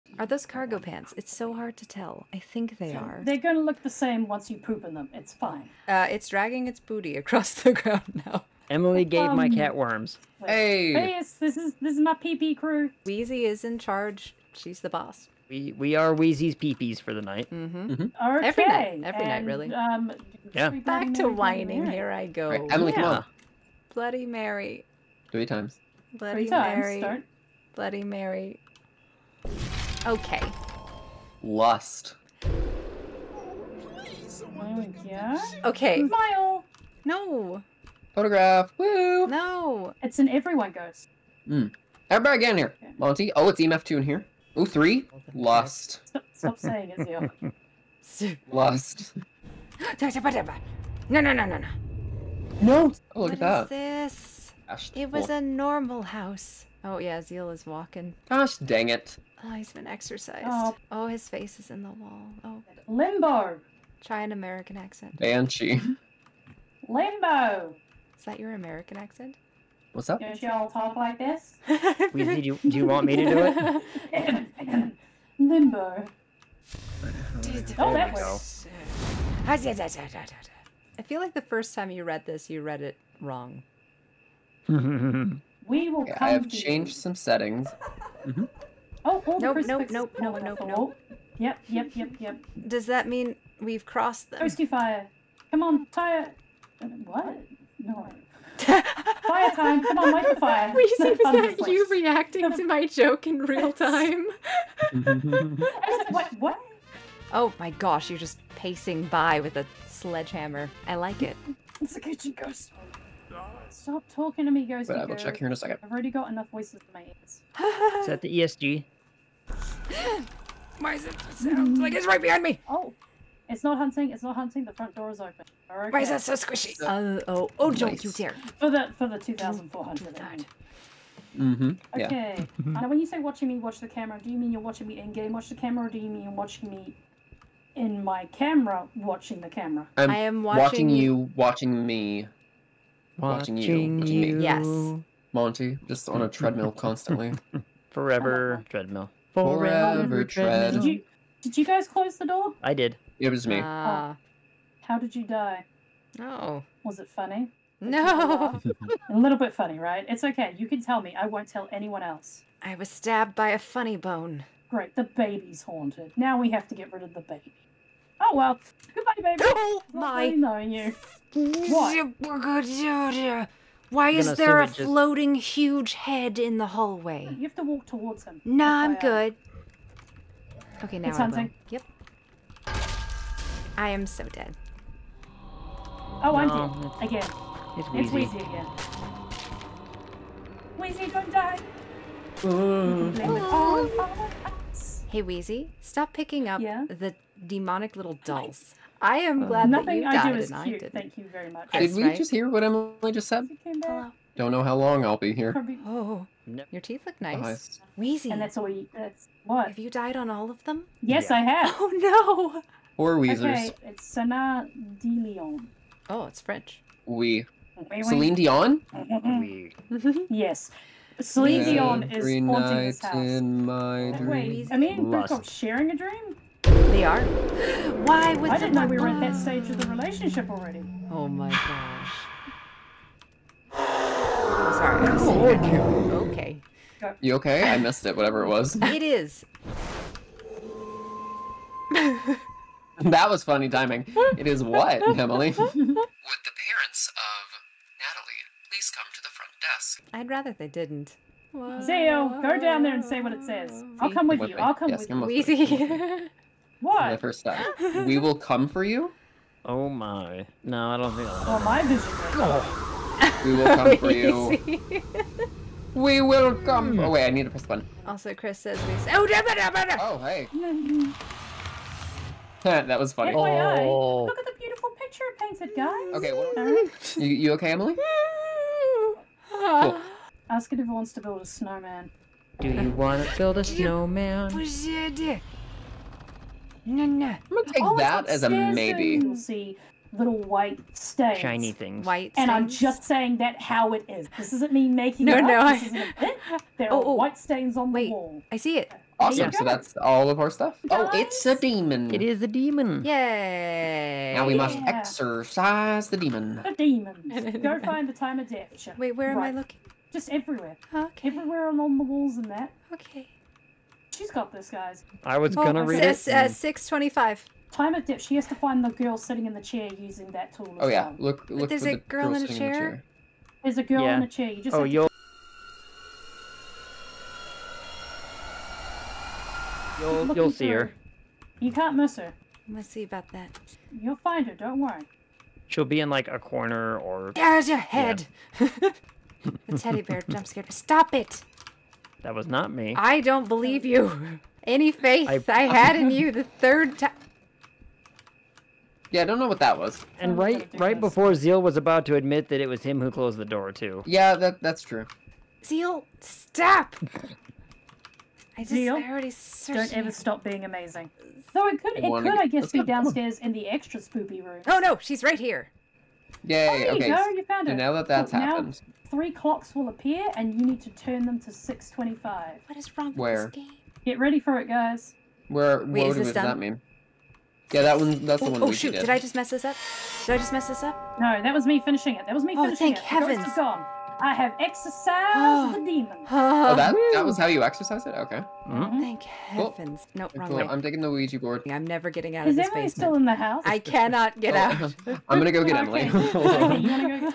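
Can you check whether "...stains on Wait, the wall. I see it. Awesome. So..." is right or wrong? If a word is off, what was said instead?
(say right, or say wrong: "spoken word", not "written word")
right.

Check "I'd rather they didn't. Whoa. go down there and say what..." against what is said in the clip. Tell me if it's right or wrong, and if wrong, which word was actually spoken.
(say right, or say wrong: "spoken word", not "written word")
right.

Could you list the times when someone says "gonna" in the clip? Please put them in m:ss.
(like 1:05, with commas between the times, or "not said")
4:47, 5:15.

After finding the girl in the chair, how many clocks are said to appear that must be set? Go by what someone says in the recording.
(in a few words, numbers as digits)
3.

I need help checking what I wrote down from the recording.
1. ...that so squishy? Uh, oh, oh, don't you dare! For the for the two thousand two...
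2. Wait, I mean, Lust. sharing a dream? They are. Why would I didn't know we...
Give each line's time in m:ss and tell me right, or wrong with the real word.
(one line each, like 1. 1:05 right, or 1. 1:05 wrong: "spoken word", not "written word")
1. 2:06 wrong: "four", not "two"
2. 3:44 right.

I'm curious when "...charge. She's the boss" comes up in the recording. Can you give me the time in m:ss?
0:13.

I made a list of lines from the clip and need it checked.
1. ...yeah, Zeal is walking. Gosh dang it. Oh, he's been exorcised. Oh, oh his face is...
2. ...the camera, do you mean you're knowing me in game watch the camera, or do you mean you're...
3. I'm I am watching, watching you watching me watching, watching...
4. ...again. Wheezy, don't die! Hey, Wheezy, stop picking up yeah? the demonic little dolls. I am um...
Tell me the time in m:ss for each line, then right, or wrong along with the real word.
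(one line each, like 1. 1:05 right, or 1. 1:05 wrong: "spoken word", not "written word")
1. 0:56 right
2. 2:13 wrong: "watching", not "knowing"
3. 2:19 right
4. 3:08 right.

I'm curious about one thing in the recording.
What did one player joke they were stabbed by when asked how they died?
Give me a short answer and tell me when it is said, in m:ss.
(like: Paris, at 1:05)
A funny bone, at 2:43.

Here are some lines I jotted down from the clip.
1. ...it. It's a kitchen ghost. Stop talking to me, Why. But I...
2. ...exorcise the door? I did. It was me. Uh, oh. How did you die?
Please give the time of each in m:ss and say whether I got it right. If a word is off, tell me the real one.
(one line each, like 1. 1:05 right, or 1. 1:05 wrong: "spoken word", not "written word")
1. 1:51 wrong: "Ghost", not "Why"
2. 2:31 wrong: "close", not "exorcise".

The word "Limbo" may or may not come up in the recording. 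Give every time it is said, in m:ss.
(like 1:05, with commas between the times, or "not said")
1:02, 1:06, 1:15.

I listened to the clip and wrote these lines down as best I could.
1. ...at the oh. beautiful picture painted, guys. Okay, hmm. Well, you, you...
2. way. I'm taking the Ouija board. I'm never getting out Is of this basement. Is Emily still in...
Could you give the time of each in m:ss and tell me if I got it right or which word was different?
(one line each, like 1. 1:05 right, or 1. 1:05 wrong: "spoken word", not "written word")
1. 4:34 right
2. 6:30 right.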